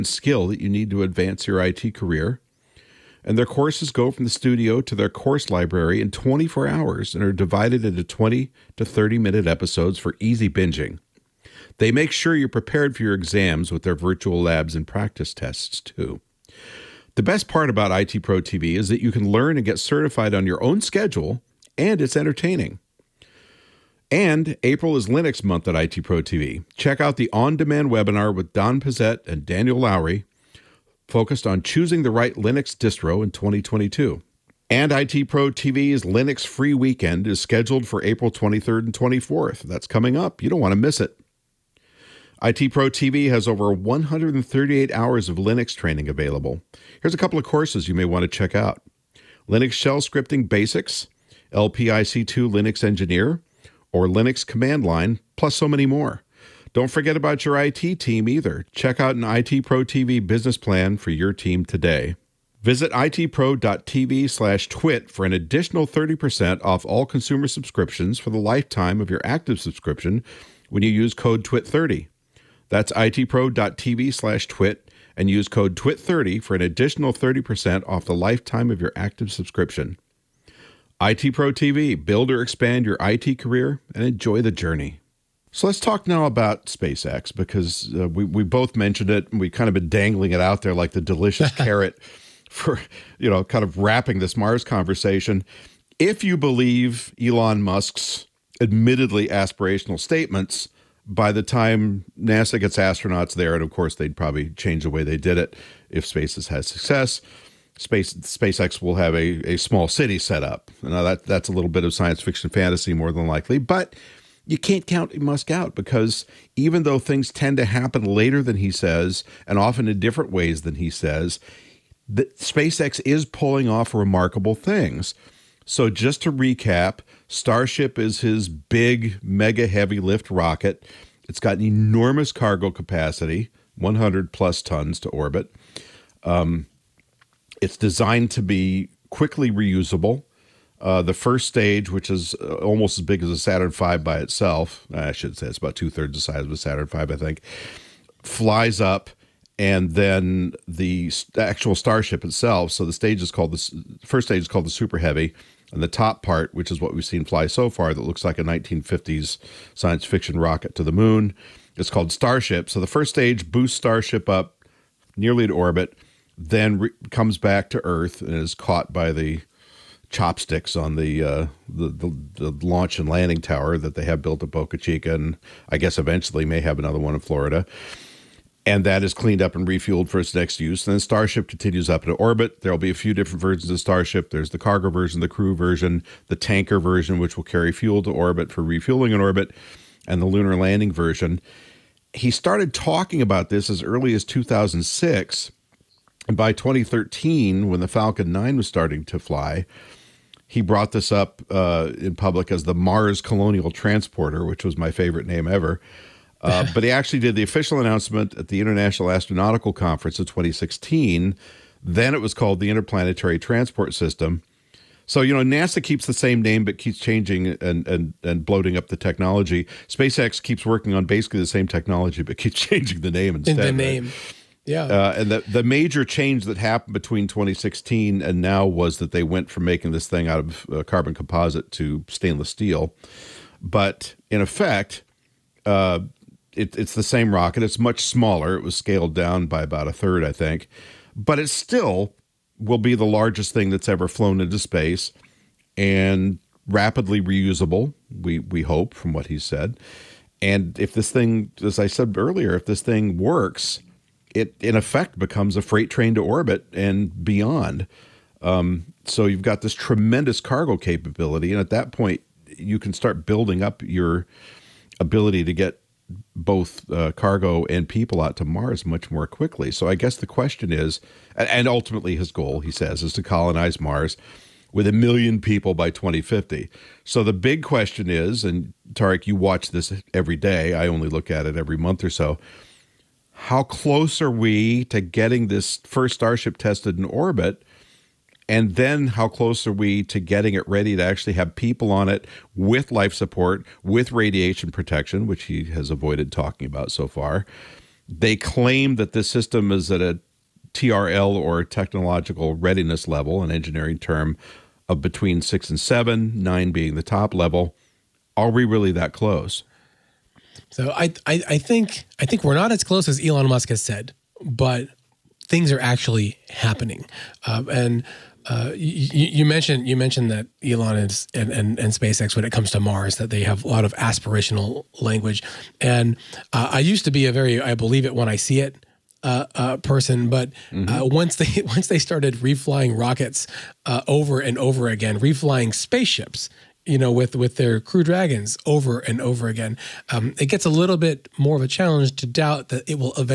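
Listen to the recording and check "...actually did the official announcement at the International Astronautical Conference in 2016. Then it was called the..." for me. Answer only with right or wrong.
right.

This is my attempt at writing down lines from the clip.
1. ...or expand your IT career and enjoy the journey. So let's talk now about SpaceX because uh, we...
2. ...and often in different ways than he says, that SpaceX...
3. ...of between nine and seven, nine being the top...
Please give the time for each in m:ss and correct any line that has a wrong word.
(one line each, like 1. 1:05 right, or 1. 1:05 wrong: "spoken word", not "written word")
1. 1:22 right
2. 1:59 right
3. 5:04 wrong: "six", not "nine".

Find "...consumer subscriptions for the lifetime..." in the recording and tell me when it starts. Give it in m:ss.
1:07.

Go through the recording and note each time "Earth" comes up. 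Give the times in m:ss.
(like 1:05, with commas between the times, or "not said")
2:47.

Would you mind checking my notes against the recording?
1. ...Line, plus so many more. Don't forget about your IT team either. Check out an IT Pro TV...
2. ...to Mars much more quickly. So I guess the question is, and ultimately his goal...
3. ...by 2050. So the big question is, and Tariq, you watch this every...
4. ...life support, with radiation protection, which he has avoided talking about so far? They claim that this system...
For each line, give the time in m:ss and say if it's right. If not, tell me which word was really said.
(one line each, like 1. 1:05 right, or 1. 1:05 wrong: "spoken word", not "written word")
1. 0:54 right
2. 4:28 right
3. 4:35 right
4. 4:52 right.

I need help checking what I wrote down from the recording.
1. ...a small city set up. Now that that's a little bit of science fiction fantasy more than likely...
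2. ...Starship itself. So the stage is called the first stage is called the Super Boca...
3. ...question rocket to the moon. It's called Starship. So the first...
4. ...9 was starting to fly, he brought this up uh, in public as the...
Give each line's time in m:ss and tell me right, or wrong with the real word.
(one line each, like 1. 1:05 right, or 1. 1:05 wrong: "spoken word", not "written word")
1. 1:49 right
2. 2:31 wrong: "Heavy", not "Boca"
3. 2:40 wrong: "fiction", not "question"
4. 3:18 right.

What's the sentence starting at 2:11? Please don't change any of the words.
It's got an enormous cargo capacity, 100 plus tons to orbit.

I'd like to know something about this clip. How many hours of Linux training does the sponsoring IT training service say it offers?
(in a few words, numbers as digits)
138.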